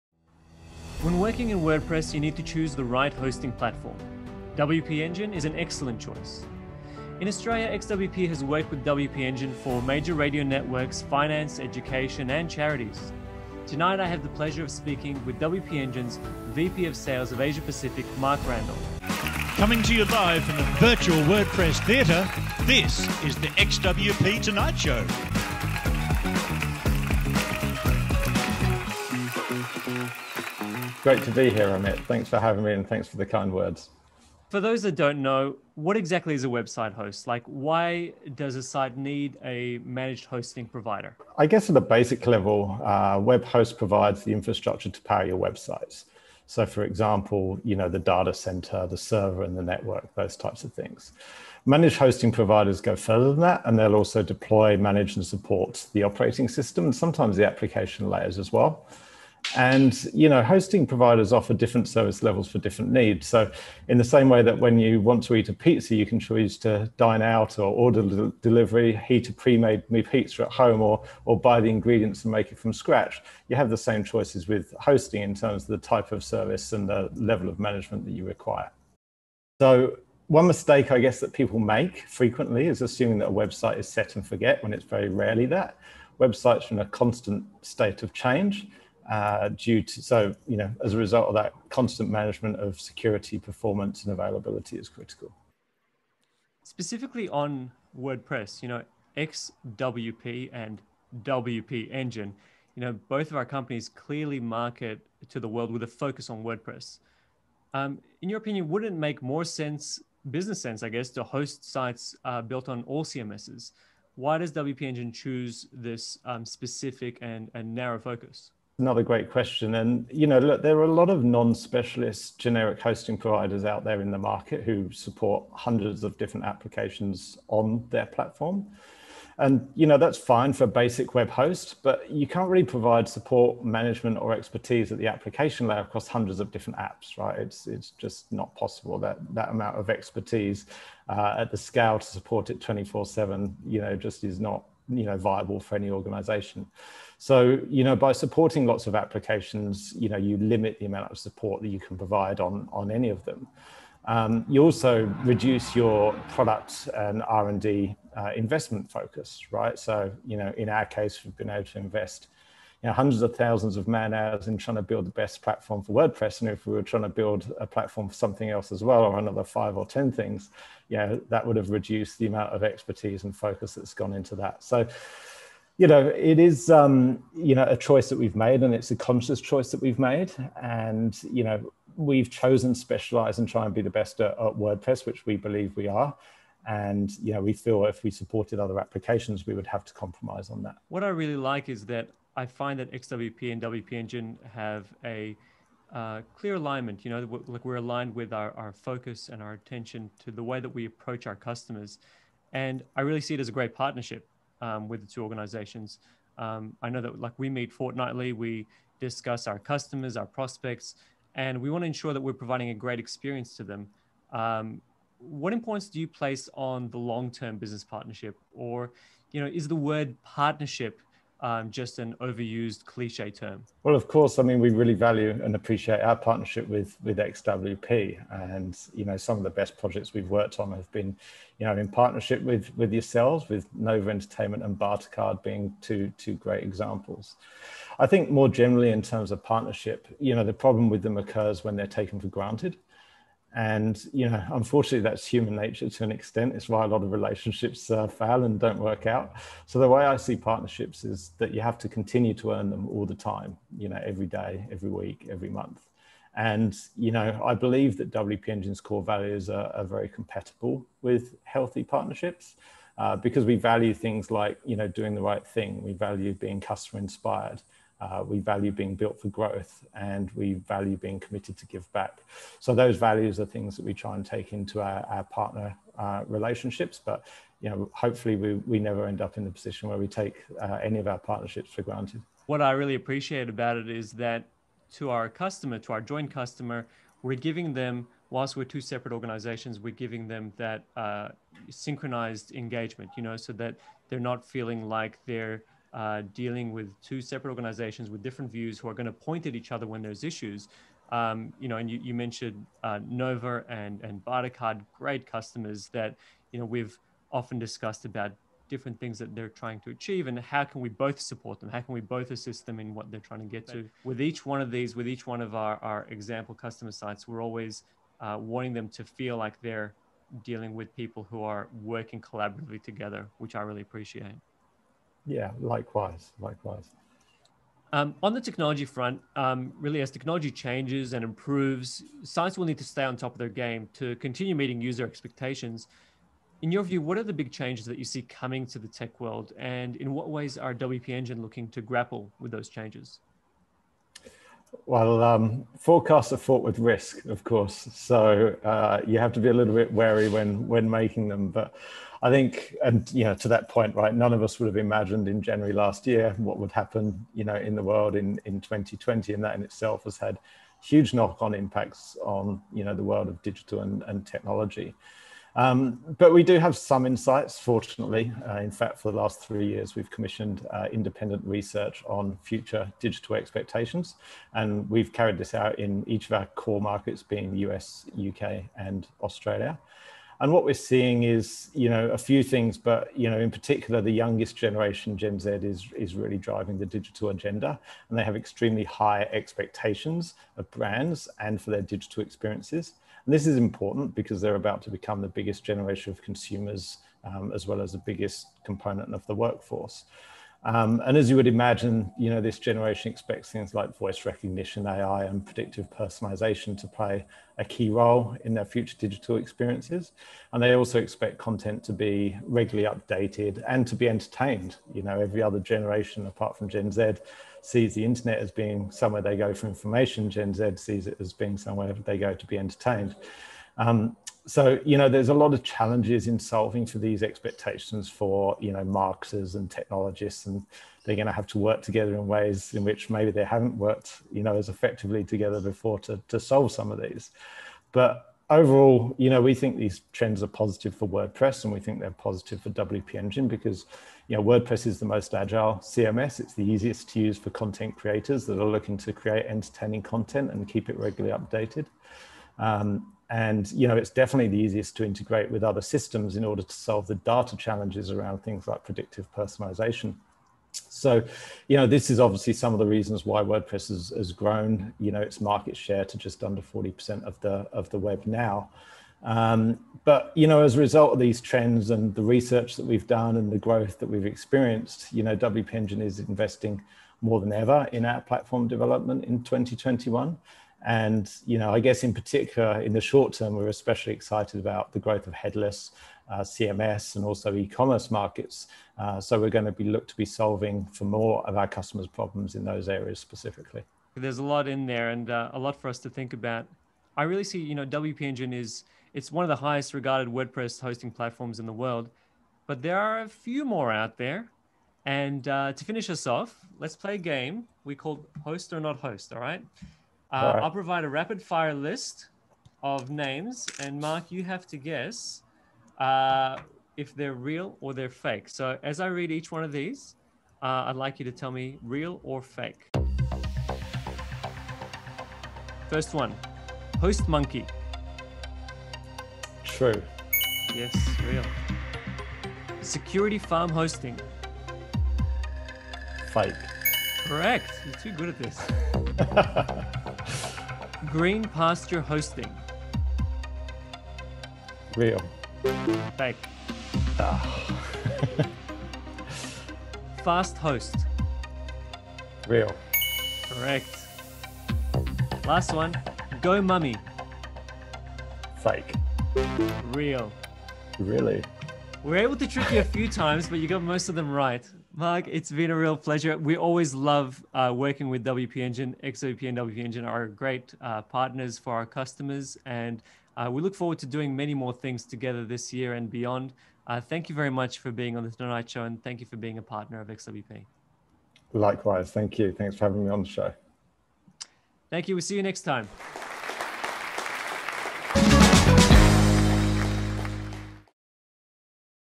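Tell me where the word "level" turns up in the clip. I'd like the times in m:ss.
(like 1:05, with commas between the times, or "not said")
0:42, 1:02, 1:17.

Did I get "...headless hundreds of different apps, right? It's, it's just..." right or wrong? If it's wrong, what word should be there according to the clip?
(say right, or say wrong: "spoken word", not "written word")
wrong: "across", not "headless".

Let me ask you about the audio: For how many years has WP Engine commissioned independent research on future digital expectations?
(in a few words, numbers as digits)
3.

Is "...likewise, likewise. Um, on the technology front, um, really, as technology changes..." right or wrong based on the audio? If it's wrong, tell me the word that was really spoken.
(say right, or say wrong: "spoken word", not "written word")
right.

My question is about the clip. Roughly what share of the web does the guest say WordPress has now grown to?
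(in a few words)
Just under 40%.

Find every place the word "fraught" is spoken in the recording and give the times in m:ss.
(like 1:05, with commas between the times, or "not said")
5:46.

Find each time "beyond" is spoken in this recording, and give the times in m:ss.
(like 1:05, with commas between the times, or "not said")
9:36.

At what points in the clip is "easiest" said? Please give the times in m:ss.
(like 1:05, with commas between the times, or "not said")
7:26, 7:34.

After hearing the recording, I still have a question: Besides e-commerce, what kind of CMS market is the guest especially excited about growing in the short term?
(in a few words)
Headless.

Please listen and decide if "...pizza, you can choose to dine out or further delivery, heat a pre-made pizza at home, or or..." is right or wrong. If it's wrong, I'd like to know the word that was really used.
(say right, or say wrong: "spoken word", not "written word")
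wrong: "order", not "further".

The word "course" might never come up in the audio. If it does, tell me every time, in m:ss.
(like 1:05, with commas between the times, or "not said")
3:44, 5:47.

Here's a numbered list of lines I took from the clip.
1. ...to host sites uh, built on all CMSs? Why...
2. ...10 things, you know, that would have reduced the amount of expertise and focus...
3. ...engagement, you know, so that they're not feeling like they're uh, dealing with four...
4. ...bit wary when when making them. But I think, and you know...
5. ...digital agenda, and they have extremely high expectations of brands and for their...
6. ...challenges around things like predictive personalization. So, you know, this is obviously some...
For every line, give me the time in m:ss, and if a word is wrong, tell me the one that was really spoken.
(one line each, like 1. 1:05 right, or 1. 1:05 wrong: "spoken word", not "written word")
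1. 1:51 right
2. 2:49 right
3. 4:52 wrong: "two", not "four"
4. 5:49 right
5. 6:26 right
6. 7:37 right.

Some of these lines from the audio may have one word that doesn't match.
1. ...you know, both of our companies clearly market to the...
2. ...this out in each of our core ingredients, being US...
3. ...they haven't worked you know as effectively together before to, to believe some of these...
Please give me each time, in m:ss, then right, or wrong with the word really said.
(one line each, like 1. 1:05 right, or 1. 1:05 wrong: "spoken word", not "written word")
1. 1:42 right
2. 6:15 wrong: "markets", not "ingredients"
3. 7:13 wrong: "solve", not "believe".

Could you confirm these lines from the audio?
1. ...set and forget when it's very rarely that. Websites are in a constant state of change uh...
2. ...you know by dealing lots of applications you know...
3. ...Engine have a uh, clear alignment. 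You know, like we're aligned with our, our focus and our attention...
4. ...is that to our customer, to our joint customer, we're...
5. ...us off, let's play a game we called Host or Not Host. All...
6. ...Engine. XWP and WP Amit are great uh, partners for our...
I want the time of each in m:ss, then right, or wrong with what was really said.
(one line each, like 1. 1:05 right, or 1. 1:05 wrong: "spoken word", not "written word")
1. 1:23 right
2. 2:27 wrong: "supporting", not "dealing"
3. 3:13 right
4. 4:43 right
5. 8:26 right
6. 9:28 wrong: "Engine", not "Amit".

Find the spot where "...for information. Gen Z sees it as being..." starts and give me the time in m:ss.
6:59.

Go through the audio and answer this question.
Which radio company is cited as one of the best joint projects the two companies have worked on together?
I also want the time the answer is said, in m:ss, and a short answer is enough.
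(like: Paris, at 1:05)
Nova Entertainment, at 3:53.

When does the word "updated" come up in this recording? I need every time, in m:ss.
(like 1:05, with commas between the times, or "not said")
6:52, 7:31.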